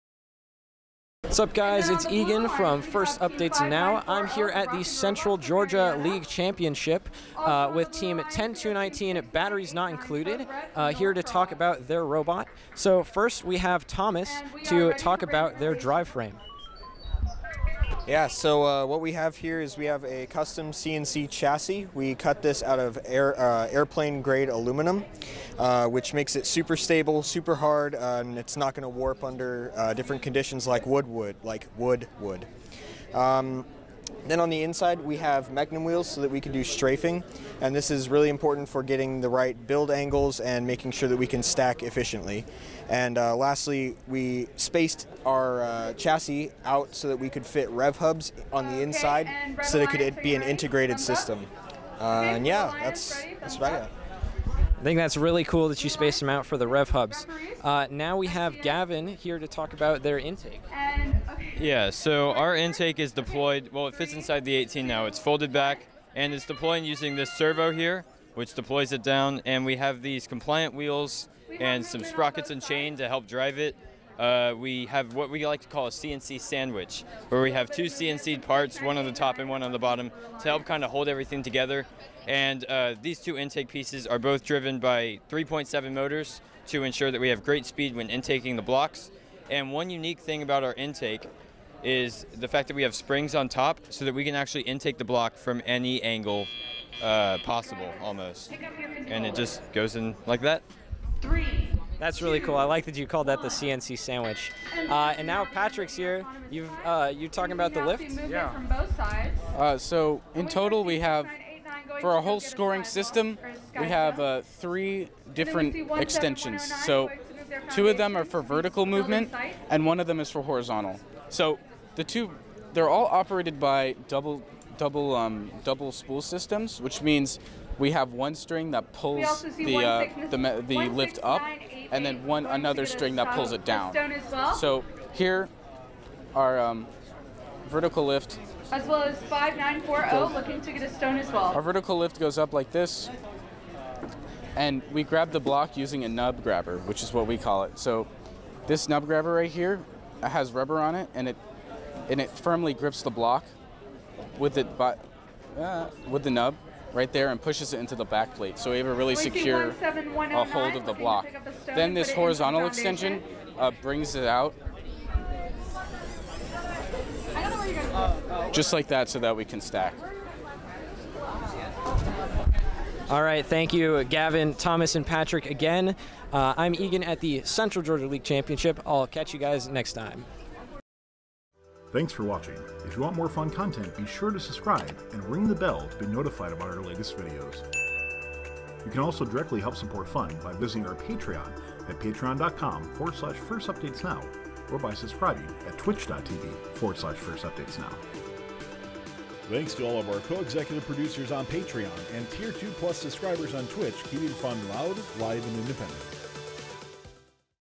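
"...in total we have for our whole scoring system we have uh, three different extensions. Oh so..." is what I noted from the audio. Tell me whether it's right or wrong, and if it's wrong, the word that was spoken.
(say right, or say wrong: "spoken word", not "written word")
right.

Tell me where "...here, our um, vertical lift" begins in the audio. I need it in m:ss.
2:15.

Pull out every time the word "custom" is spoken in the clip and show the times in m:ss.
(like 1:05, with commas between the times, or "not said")
0:20.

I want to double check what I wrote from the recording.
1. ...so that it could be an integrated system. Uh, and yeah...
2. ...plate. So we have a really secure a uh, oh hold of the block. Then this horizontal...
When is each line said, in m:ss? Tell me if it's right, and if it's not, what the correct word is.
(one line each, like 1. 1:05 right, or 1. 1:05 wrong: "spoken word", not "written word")
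1. 0:49 right
2. 2:38 right.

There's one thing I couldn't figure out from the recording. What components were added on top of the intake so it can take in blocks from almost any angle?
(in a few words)
Springs.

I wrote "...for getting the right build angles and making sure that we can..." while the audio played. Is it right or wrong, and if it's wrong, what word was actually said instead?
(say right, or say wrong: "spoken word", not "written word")
right.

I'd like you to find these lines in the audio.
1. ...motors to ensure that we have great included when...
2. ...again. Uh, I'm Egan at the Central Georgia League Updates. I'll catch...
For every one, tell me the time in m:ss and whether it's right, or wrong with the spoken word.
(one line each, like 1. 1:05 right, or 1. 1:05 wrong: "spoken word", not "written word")
1. 1:25 wrong: "speed", not "included"
2. 2:55 wrong: "Championship", not "Updates".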